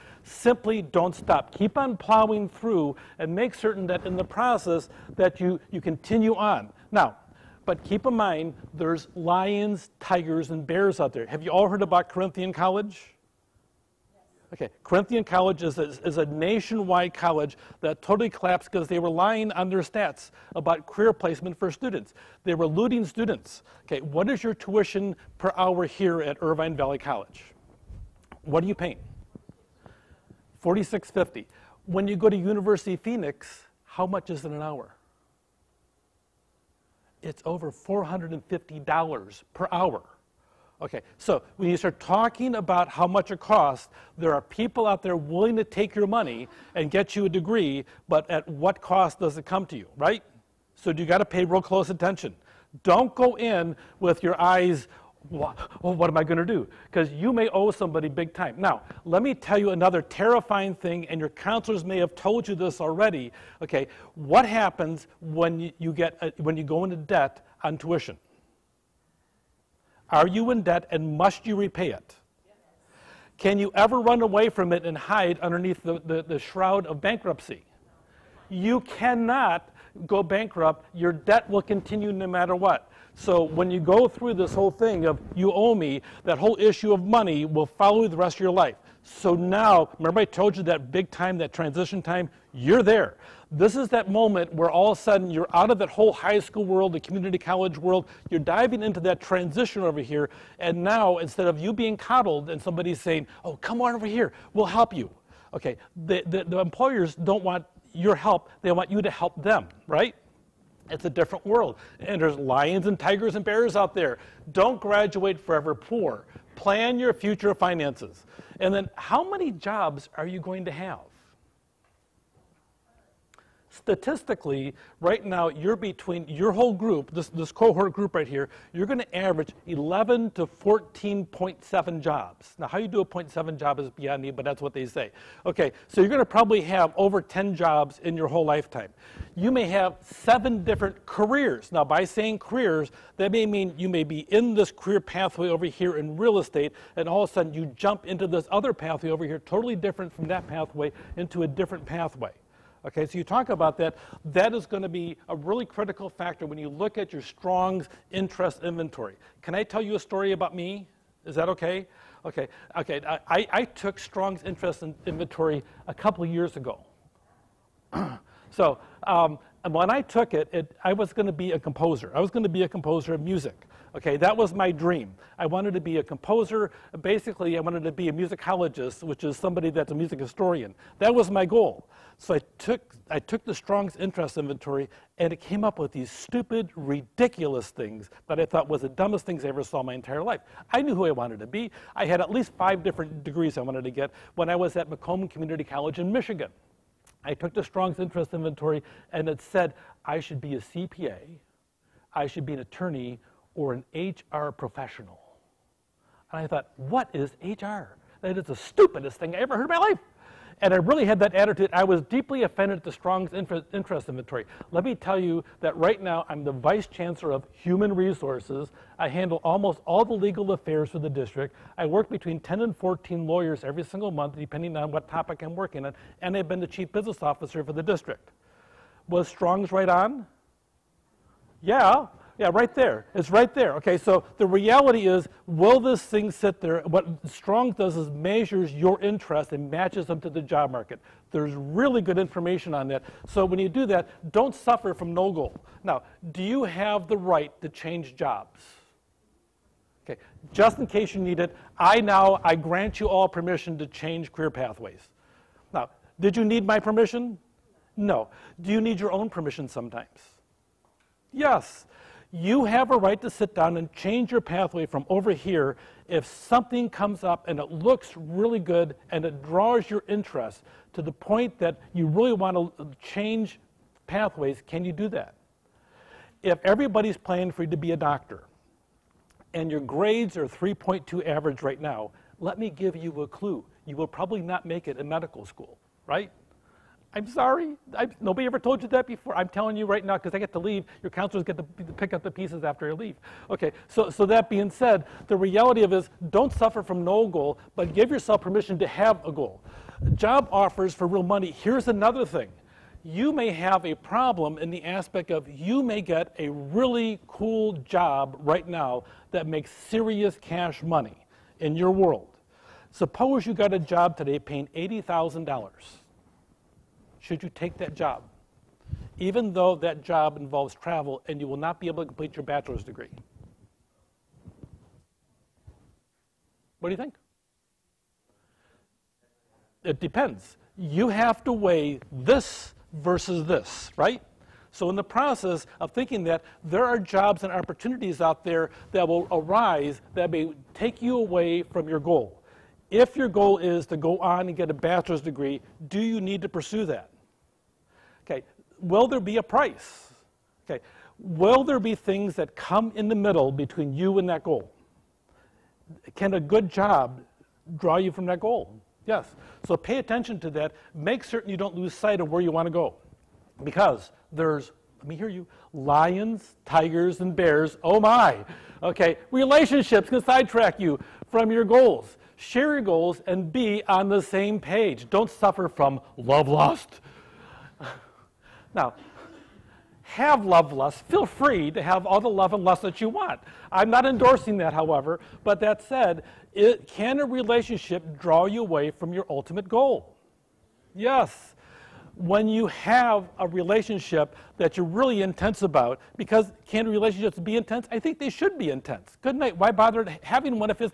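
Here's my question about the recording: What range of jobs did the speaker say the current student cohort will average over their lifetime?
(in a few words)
11 to 14.7.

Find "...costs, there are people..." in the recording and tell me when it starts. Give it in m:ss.
0:43.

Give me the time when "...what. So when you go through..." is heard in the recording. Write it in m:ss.
1:22.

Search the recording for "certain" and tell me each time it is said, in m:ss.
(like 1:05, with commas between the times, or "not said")
0:03, 6:01.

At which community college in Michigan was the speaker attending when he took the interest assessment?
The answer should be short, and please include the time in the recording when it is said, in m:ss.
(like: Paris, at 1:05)
Macomb Community College, at 3:14.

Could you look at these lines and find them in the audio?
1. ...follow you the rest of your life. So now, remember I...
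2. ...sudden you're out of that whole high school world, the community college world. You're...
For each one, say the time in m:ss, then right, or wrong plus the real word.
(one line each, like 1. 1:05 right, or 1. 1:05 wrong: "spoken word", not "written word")
1. 1:27 right
2. 1:35 right.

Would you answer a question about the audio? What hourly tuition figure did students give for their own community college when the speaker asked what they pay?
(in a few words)
46.50.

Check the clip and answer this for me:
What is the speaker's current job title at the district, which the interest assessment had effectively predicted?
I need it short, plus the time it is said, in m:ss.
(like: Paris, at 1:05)
Vice chancellor of human resources, at 3:36.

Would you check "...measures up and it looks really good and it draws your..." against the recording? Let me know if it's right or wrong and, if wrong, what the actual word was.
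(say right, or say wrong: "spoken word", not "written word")
wrong: "comes", not "measures".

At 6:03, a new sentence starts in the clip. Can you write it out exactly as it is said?
Because there's, let me hear you, lions, tigers, and bears.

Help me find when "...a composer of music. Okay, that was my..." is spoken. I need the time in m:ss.
2:52.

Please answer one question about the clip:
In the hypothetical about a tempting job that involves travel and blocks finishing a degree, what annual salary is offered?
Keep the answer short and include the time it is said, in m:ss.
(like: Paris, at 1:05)
$80,000, at 5:14.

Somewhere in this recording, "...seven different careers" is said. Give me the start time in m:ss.
2:20.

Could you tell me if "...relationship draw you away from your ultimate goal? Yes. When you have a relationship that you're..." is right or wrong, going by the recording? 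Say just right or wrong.
right.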